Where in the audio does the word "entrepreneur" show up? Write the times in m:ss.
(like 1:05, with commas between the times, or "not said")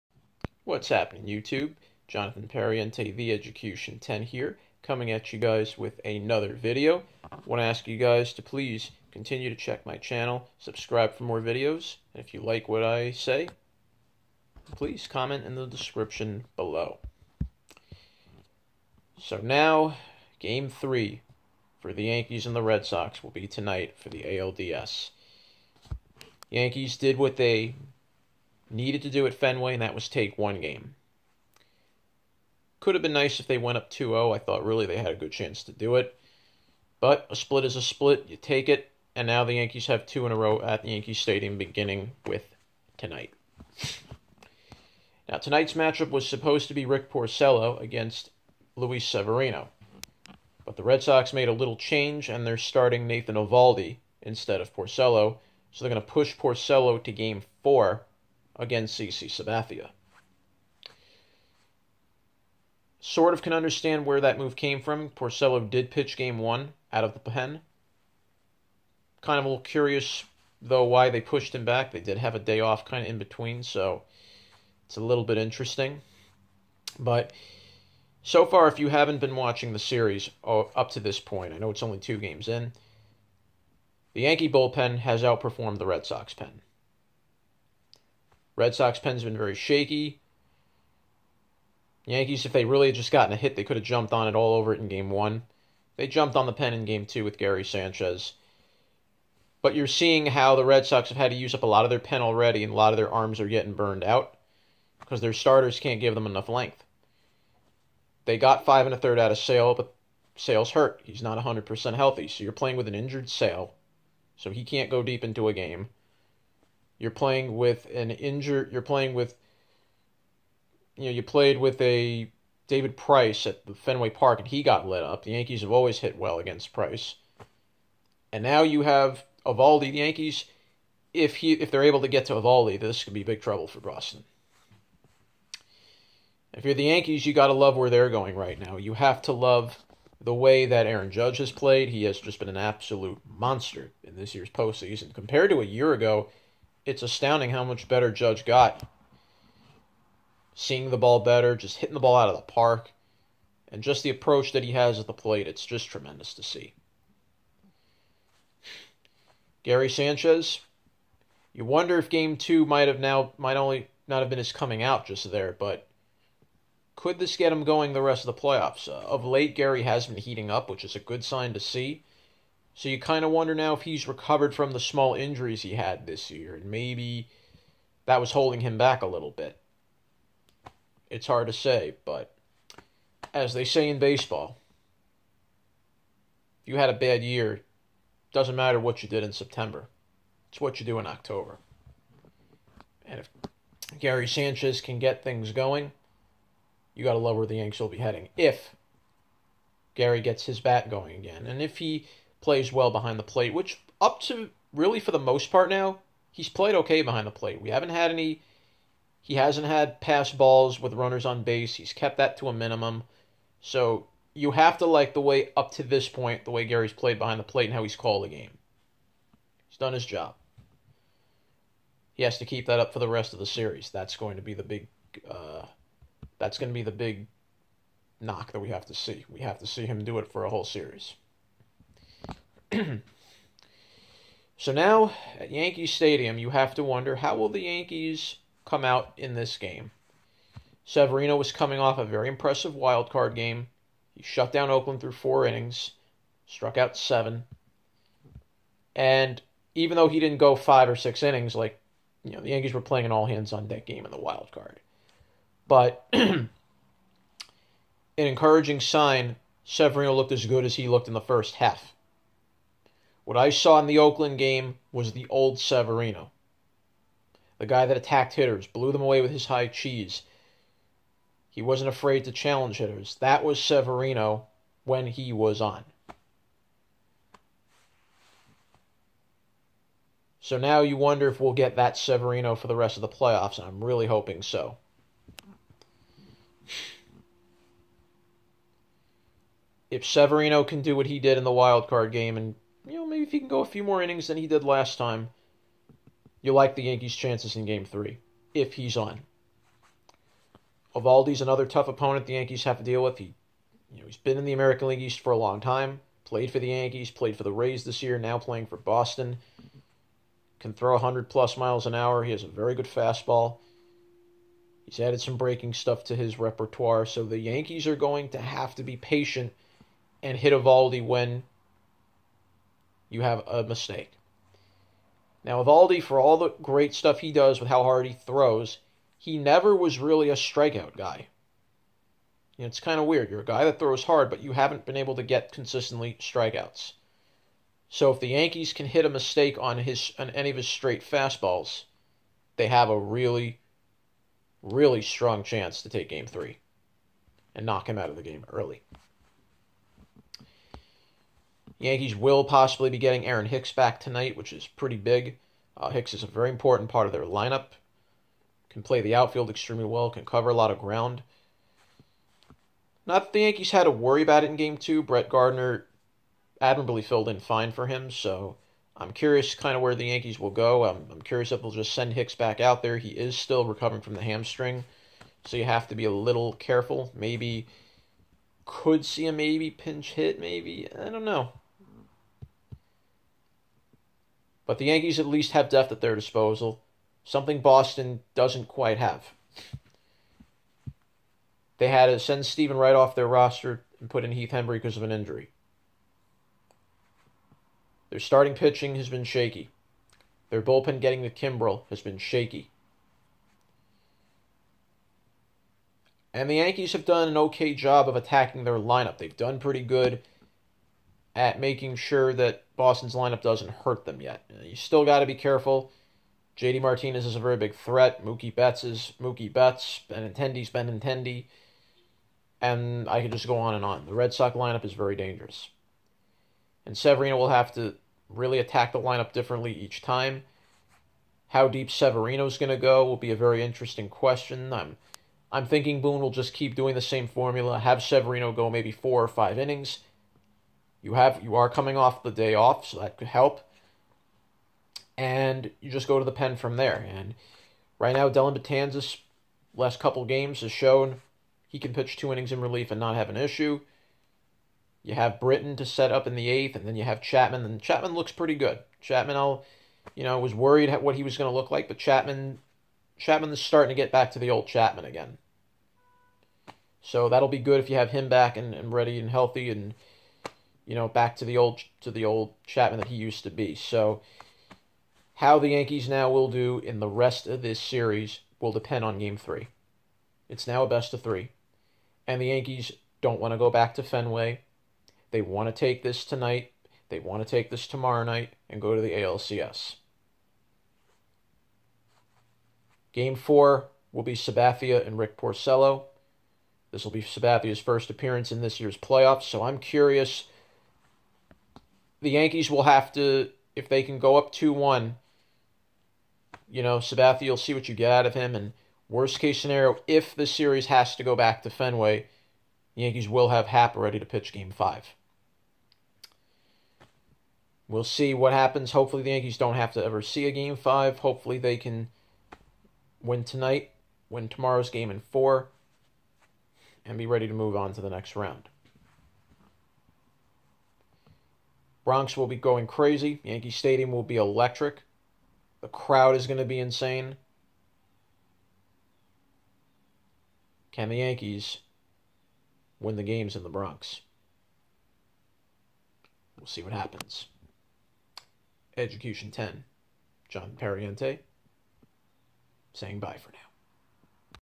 not said.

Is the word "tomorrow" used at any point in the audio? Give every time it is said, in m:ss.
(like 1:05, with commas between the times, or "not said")
8:07, 8:44.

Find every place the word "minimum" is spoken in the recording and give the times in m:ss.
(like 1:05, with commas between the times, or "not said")
3:32.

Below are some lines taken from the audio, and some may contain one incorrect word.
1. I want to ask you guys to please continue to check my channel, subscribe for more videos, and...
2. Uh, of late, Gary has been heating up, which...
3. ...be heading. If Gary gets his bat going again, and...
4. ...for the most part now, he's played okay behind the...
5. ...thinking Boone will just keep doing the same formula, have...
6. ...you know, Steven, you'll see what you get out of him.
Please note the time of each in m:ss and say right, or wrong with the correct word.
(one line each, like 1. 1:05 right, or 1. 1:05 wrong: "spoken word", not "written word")
1. 0:07 right
2. 2:48 right
3. 3:17 right
4. 3:24 right
5. 7:15 right
6. 8:26 wrong: "Sabathia", not "Steven".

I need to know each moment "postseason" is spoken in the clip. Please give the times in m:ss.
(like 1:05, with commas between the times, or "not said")
2:24.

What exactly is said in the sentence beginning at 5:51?
Yankees will possibly be getting Aaron Hicks back tonight, which is pretty big.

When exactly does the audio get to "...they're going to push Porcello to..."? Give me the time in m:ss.
0:55.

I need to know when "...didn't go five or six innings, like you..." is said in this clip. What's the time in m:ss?
4:10.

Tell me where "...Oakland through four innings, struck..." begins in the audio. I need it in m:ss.
4:04.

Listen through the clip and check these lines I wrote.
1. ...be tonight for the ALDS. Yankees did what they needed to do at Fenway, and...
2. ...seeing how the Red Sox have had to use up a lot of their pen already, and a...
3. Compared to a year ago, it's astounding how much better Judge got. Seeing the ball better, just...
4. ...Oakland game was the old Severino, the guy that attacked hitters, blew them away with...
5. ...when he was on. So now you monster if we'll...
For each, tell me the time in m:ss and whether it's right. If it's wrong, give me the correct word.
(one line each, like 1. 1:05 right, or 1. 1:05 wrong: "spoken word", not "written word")
1. 0:23 right
2. 1:39 right
3. 2:25 right
4. 4:23 right
5. 4:34 wrong: "wonder", not "monster".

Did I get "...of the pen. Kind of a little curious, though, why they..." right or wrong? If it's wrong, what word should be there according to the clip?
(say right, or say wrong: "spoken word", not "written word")
right.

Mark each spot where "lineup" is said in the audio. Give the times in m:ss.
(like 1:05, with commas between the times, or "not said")
5:57, 6:48, 6:53, 7:04, 7:08.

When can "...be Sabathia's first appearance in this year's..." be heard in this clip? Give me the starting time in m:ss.
8:17.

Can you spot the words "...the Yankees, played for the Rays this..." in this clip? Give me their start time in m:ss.
5:06.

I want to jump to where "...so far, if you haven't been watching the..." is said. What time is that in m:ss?
1:18.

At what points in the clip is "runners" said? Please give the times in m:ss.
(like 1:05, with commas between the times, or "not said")
3:30.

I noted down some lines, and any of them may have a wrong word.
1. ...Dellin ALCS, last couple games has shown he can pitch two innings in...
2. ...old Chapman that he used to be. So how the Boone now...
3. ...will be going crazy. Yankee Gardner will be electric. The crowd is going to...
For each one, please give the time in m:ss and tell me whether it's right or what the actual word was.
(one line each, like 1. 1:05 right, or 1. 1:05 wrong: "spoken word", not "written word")
1. 7:28 wrong: "Betances", not "ALCS"
2. 7:52 wrong: "Yankees", not "Boone"
3. 8:52 wrong: "Stadium", not "Gardner".